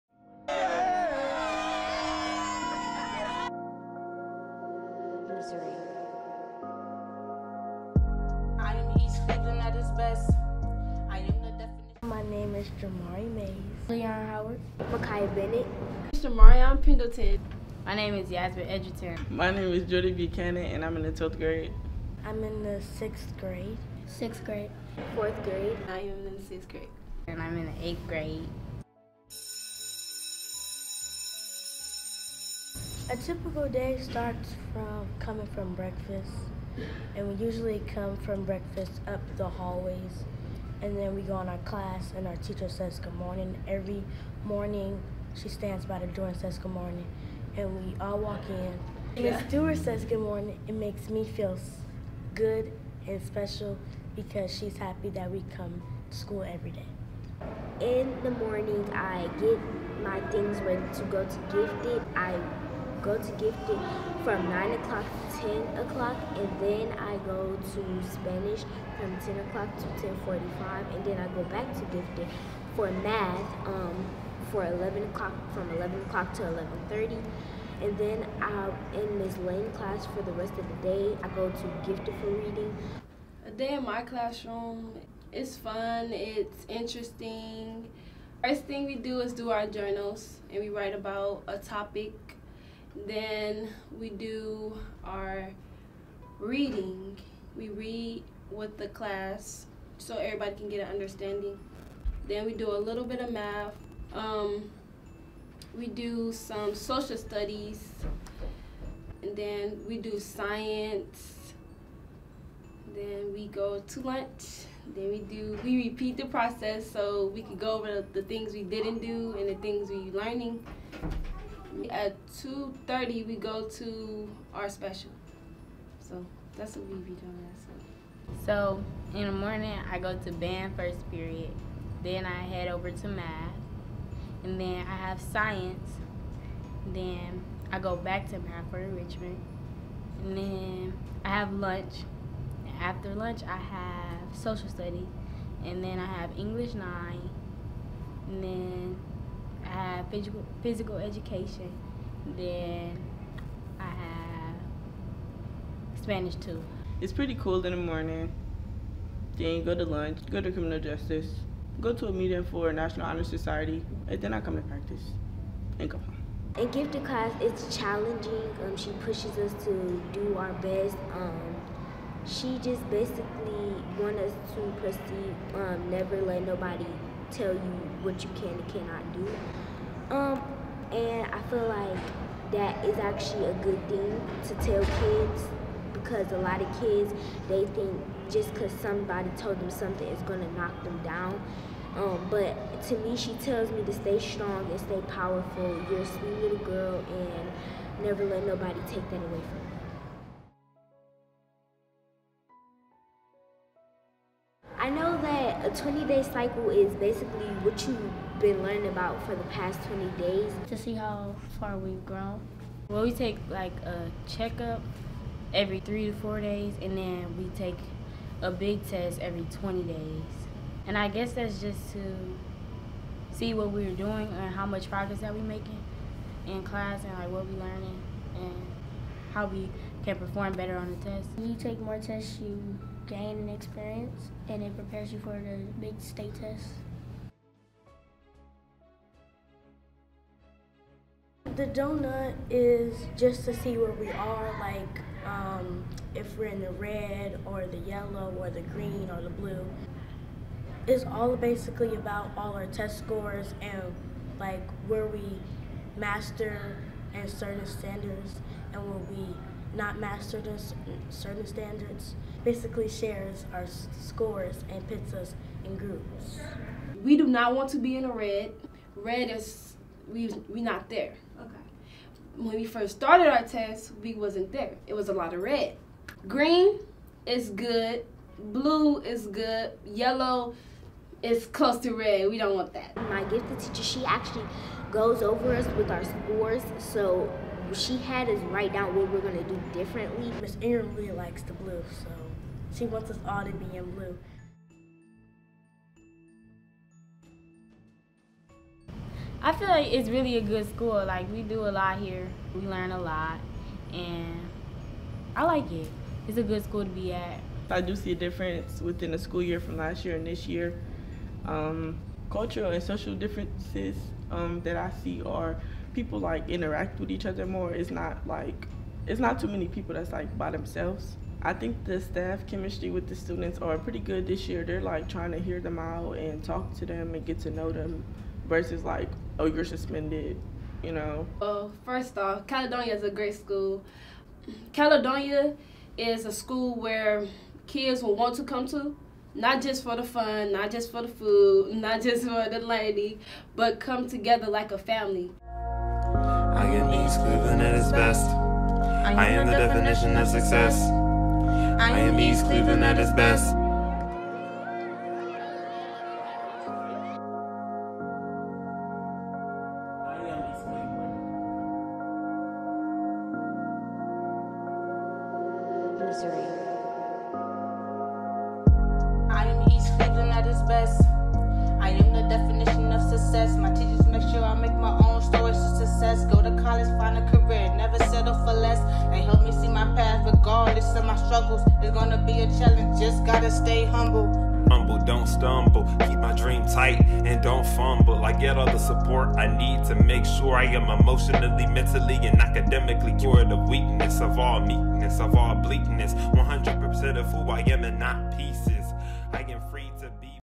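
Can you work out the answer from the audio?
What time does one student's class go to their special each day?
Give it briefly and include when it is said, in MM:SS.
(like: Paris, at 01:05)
2:30, at 02:01.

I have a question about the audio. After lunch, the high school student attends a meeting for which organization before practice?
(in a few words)
National Honor Society.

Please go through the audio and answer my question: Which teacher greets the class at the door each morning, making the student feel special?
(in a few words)
Miss Stewart.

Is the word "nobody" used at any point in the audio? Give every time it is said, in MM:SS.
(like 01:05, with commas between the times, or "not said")
02:56, 03:18.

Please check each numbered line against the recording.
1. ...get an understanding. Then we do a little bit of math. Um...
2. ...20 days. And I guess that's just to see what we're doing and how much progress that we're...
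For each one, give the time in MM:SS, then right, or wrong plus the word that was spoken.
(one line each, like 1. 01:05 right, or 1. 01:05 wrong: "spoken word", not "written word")
1. 01:40 right
2. 03:39 right.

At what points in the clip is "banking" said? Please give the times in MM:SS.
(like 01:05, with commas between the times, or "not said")
not said.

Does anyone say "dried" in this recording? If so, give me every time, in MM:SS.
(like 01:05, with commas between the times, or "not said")
not said.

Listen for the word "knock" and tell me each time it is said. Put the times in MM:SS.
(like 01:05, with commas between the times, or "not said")
03:10.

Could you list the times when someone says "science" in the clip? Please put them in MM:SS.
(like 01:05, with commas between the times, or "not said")
01:50, 02:15.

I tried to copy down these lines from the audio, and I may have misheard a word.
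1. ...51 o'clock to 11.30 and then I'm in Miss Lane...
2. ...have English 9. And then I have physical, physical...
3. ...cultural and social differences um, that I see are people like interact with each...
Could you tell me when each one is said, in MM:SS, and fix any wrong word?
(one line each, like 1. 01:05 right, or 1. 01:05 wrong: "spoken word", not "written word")
1. 01:15 wrong: "11", not "51"
2. 02:26 right
3. 05:12 right.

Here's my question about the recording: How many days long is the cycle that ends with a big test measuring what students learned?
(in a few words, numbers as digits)
20.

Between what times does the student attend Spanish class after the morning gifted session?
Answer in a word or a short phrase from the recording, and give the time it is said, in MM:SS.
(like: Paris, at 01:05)
10:00 to 10:45, at 01:09.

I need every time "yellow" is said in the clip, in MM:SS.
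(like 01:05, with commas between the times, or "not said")
04:07, 04:39.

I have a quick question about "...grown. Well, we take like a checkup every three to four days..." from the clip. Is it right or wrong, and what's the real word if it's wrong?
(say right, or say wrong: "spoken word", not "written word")
right.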